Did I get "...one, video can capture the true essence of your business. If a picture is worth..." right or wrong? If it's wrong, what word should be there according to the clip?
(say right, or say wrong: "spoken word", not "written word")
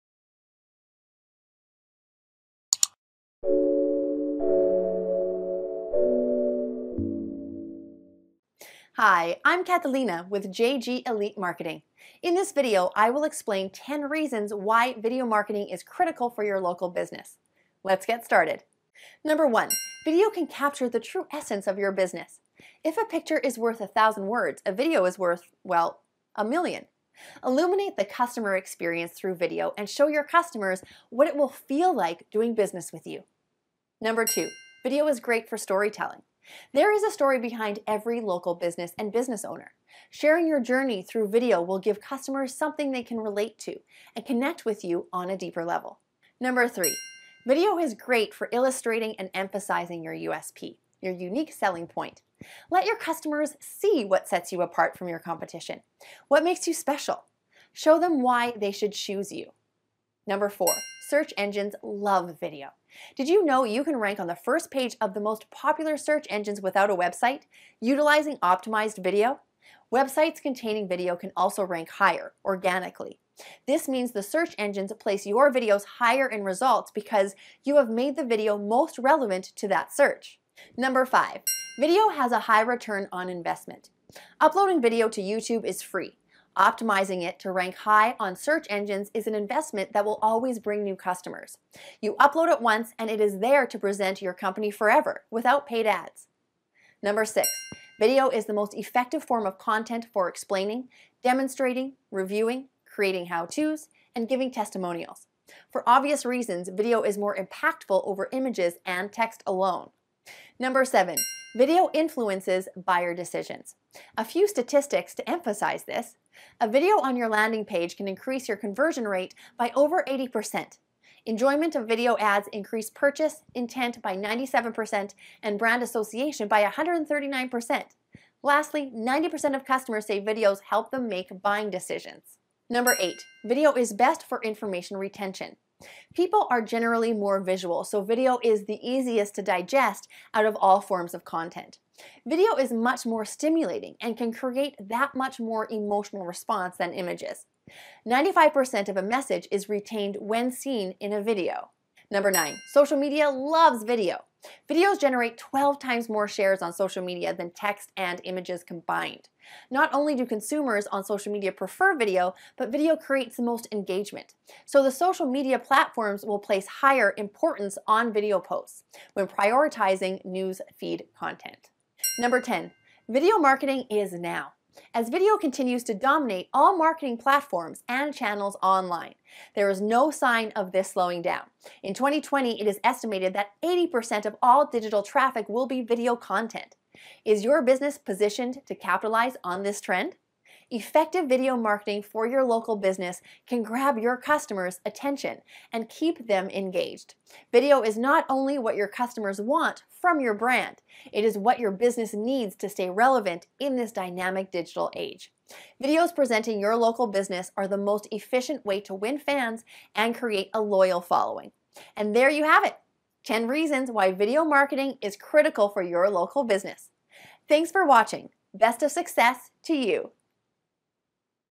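right.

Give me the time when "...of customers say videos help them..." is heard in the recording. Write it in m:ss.
2:09.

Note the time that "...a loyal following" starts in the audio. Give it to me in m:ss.
3:30.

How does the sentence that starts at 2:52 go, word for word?
Number 10, video marketing is now as video continues to dominate all marketing platforms and channels online.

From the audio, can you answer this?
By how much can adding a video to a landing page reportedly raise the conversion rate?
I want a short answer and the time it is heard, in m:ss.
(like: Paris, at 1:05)
over 80%, at 1:59.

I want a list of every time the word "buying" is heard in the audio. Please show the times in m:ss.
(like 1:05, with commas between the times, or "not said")
2:11.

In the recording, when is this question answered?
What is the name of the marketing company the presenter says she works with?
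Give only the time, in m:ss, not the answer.
0:10.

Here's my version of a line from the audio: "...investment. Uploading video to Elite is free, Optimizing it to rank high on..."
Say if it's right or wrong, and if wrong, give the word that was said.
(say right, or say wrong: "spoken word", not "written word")
wrong: "YouTube", not "Elite".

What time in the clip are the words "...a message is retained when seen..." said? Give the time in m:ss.
2:28.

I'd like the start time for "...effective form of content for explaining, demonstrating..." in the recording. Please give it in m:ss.
1:38.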